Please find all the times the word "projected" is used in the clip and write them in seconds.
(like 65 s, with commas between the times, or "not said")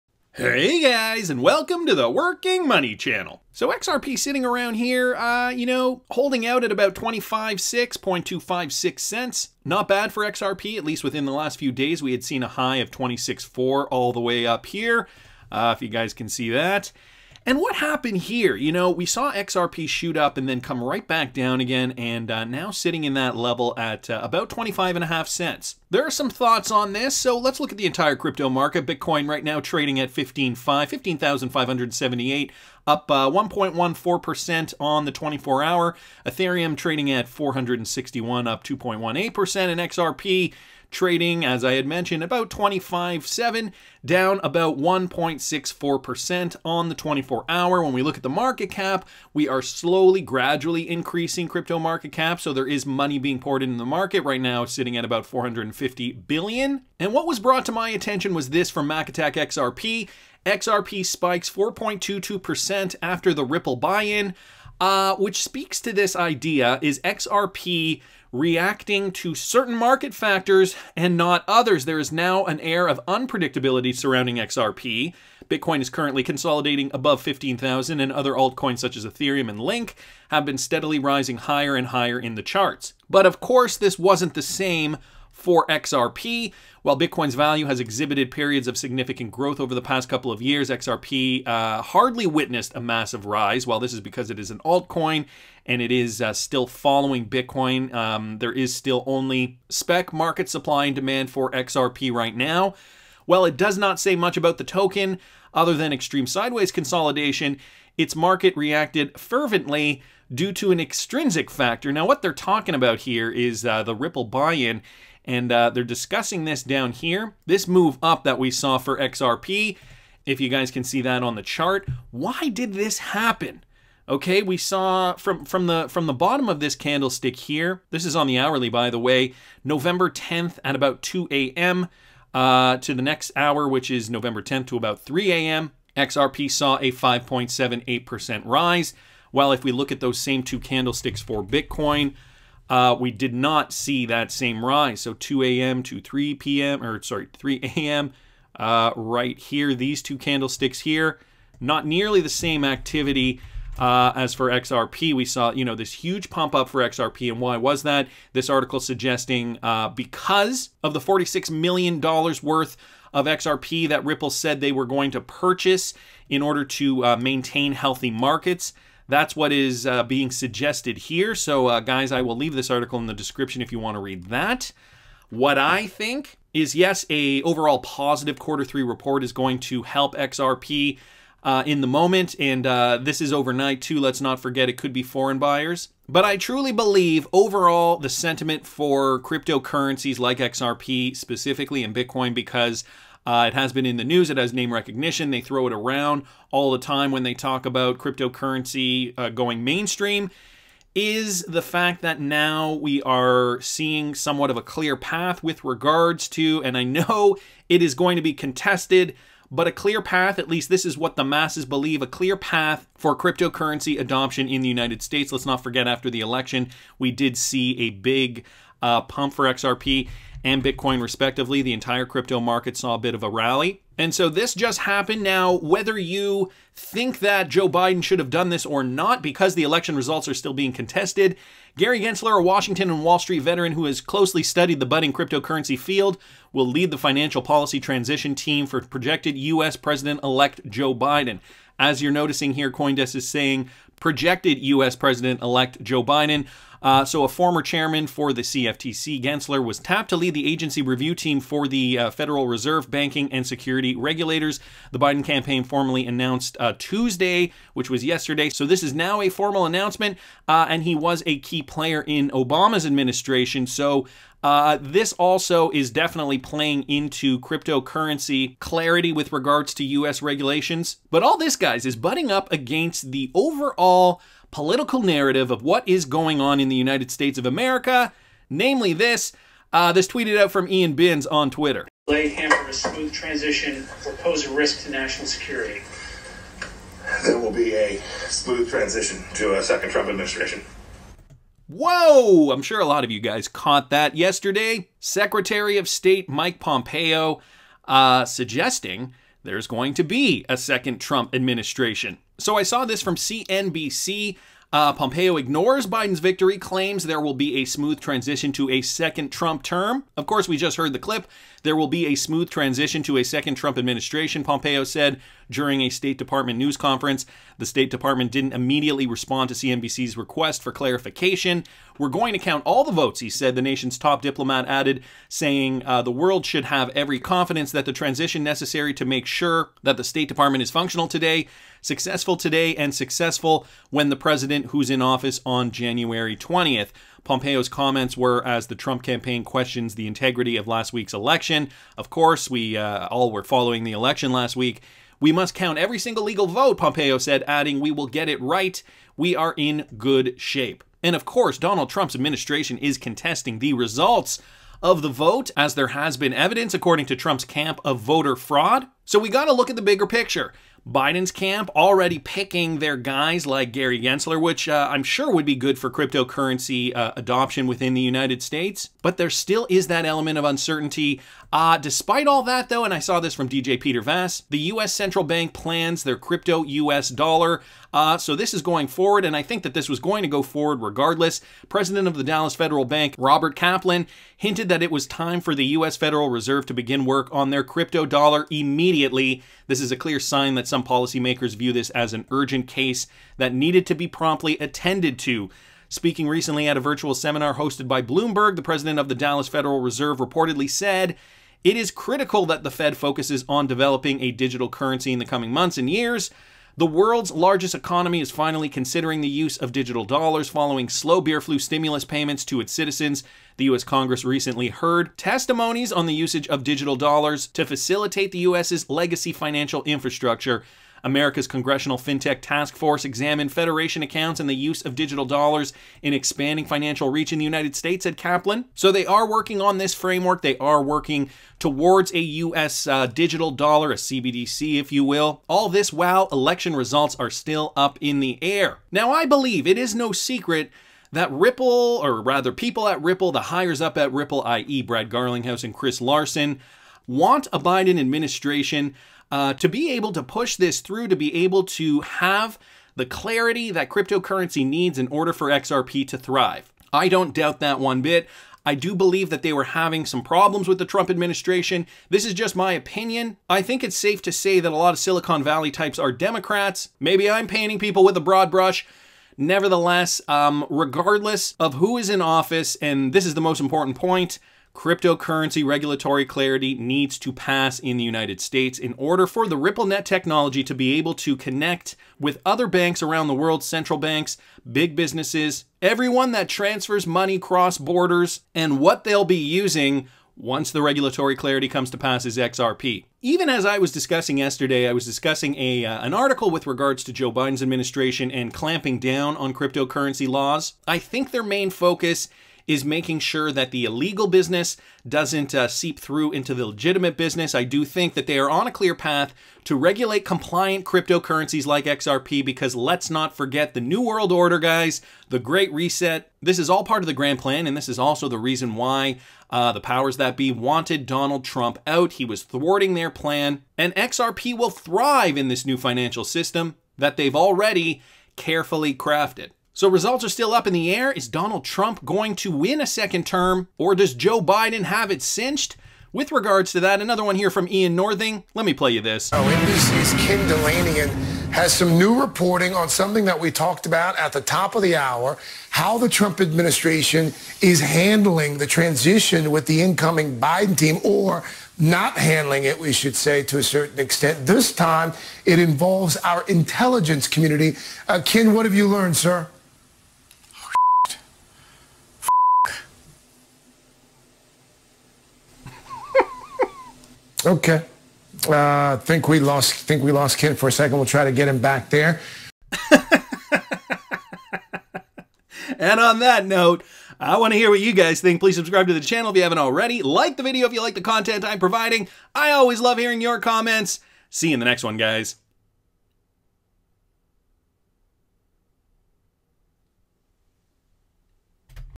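238 s, 243 s.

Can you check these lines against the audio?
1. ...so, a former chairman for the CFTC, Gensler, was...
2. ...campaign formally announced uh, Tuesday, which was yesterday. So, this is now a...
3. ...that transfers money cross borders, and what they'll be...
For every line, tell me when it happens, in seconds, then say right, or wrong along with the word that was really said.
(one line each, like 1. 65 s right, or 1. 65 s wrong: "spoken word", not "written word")
1. 247 s right
2. 255 s right
3. 486 s right.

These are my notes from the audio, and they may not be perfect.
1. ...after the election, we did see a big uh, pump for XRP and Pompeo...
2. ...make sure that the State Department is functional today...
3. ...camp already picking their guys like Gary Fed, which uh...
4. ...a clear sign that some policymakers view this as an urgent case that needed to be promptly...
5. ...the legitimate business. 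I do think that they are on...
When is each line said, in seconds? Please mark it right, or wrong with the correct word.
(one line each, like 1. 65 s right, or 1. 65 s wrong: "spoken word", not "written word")
1. 215 s wrong: "Bitcoin", not "Pompeo"
2. 329 s right
3. 361 s wrong: "Gensler", not "Fed"
4. 389 s right
5. 506 s right.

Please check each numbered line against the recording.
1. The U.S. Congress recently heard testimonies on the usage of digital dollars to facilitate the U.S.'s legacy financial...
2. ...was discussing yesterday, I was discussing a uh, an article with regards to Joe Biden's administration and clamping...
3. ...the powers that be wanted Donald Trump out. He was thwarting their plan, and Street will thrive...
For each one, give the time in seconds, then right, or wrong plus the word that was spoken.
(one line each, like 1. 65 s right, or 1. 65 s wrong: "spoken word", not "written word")
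1. 413 s right
2. 493 s right
3. 519 s wrong: "XRP", not "Street".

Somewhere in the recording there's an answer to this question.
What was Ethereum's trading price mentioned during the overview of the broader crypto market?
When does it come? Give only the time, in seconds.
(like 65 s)
37 s.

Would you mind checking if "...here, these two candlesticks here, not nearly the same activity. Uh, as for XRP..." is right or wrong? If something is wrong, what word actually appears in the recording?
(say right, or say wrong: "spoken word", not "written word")
right.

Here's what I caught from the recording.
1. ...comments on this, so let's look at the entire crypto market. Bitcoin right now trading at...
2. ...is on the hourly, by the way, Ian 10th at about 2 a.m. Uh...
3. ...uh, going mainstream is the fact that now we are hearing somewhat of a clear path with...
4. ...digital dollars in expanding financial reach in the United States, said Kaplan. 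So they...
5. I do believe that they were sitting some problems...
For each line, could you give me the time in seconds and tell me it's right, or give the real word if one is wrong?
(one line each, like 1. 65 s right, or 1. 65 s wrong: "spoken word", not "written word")
1. 26 s wrong: "thoughts", not "comments"
2. 128 s wrong: "November", not "Ian"
3. 199 s wrong: "seeing", not "hearing"
4. 424 s right
5. 458 s wrong: "having", not "sitting".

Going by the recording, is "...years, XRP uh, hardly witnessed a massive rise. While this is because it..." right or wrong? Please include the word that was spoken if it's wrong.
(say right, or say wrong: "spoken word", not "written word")
right.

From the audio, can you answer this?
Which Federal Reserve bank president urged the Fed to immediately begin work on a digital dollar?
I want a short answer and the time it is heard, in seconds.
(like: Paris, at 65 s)
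Robert Kaplan, at 383 s.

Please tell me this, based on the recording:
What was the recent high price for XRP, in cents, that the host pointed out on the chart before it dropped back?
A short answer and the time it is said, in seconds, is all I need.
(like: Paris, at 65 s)
26.4 cents, at 12 s.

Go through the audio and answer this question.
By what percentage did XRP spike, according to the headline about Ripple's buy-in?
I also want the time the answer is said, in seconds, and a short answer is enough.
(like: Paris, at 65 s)
4.22%, at 61 s.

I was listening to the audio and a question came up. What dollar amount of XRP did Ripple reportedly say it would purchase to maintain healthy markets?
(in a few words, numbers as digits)
46 million dollars.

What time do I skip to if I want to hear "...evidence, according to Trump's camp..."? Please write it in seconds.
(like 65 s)
356 s.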